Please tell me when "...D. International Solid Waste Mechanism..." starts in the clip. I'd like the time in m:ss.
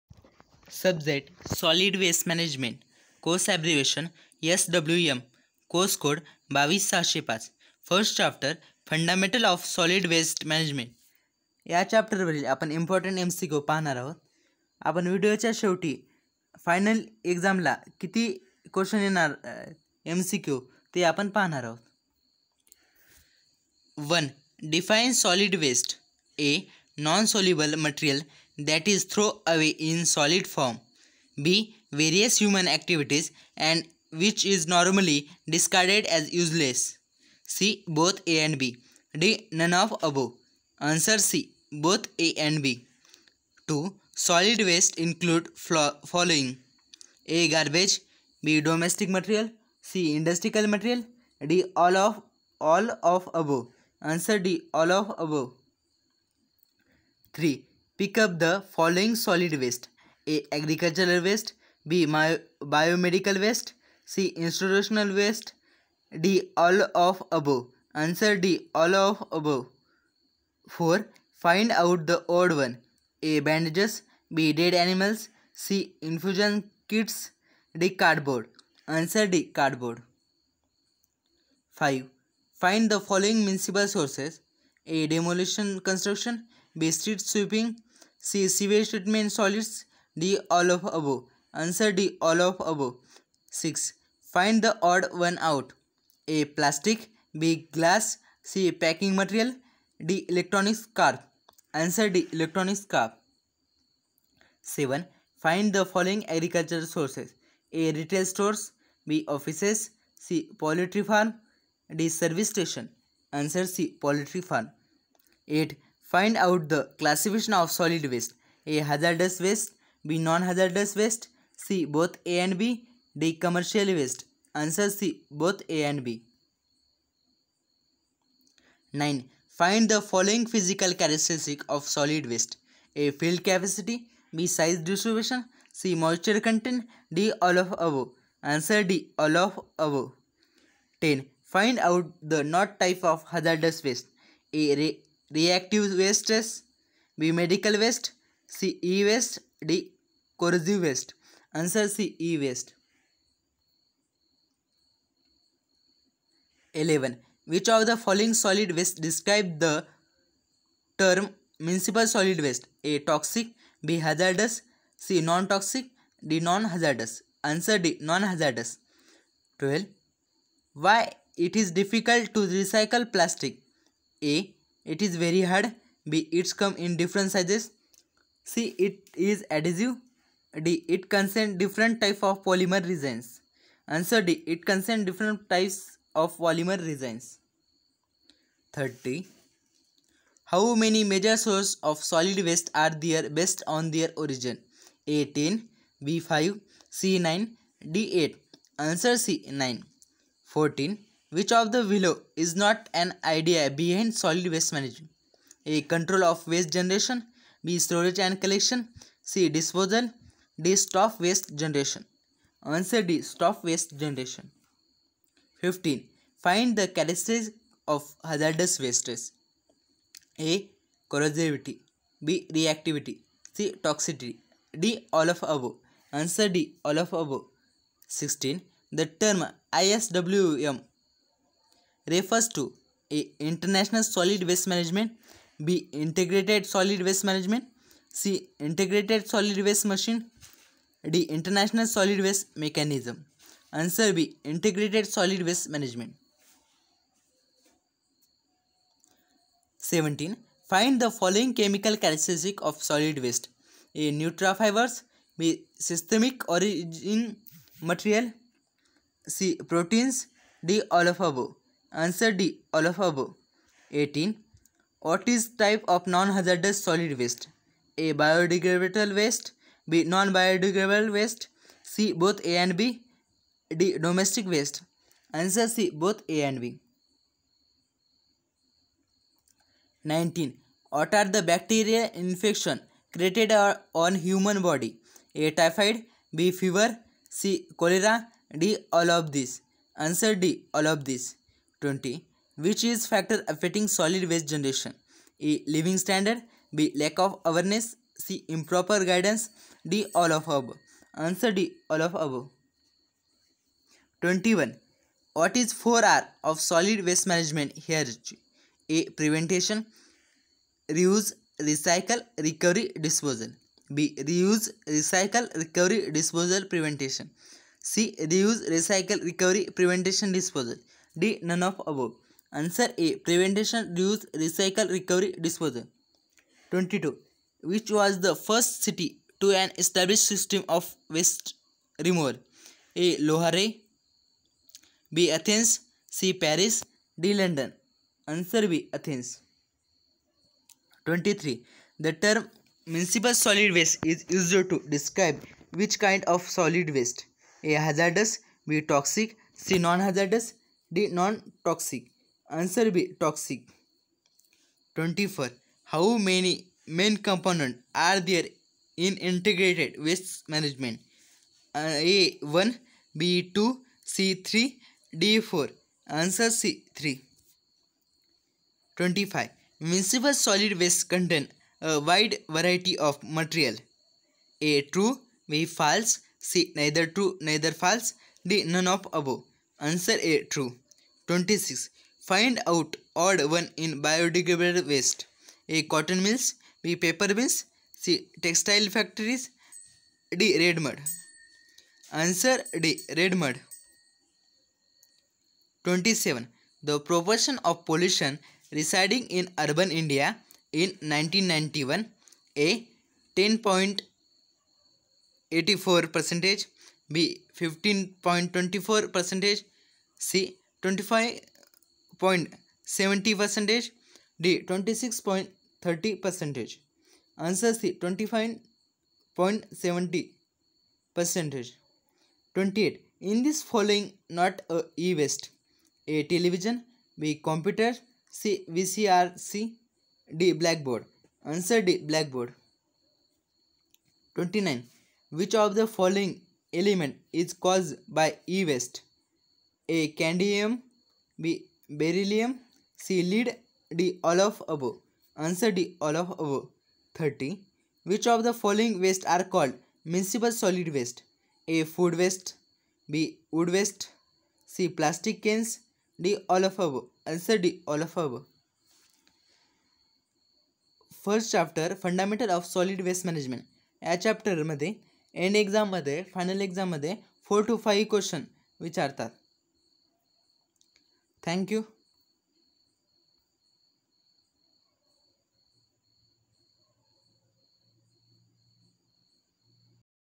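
4:01.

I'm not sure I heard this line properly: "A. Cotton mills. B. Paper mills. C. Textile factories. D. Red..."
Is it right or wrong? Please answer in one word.
right.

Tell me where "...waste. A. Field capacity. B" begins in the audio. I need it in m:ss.
2:12.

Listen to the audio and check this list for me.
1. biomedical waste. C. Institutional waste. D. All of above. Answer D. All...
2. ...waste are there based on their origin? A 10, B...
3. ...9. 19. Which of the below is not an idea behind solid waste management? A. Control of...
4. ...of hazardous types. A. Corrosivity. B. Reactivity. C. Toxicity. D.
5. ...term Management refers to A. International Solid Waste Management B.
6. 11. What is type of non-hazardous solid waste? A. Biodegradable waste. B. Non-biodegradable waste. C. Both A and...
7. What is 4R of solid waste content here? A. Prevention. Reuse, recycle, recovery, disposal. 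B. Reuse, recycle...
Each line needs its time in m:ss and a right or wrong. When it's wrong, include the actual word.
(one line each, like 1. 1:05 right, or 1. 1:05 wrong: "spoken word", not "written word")
1. 1:02 right
2. 3:12 right
3. 3:19 wrong: "14", not "19"
4. 3:37 wrong: "wastes", not "types"
5. 3:49 wrong: "ISWM", not "Management"
6. 4:23 wrong: "18", not "11"
7. 5:05 wrong: "management", not "content".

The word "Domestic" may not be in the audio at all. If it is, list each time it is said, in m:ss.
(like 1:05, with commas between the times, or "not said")
0:48, 4:33.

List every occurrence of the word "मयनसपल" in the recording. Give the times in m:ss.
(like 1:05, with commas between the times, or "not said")
6:09, 7:30.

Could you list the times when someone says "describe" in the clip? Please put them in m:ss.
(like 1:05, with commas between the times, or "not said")
2:39, 5:44.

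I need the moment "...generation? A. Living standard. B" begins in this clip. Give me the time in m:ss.
4:54.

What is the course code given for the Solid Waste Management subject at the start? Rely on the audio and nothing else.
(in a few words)
22605.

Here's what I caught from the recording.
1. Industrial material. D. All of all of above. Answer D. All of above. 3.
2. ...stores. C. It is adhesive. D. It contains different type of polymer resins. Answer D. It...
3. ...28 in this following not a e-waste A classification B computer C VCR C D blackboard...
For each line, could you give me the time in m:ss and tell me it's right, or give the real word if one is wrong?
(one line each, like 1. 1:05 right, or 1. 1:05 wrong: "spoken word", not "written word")
1. 0:50 right
2. 2:57 wrong: "sizes", not "stores"
3. 7:02 wrong: "television", not "classification".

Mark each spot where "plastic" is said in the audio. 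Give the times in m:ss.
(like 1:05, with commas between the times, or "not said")
1:36, 2:53.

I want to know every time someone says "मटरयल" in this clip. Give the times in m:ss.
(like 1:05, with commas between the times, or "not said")
0:27, 6:13.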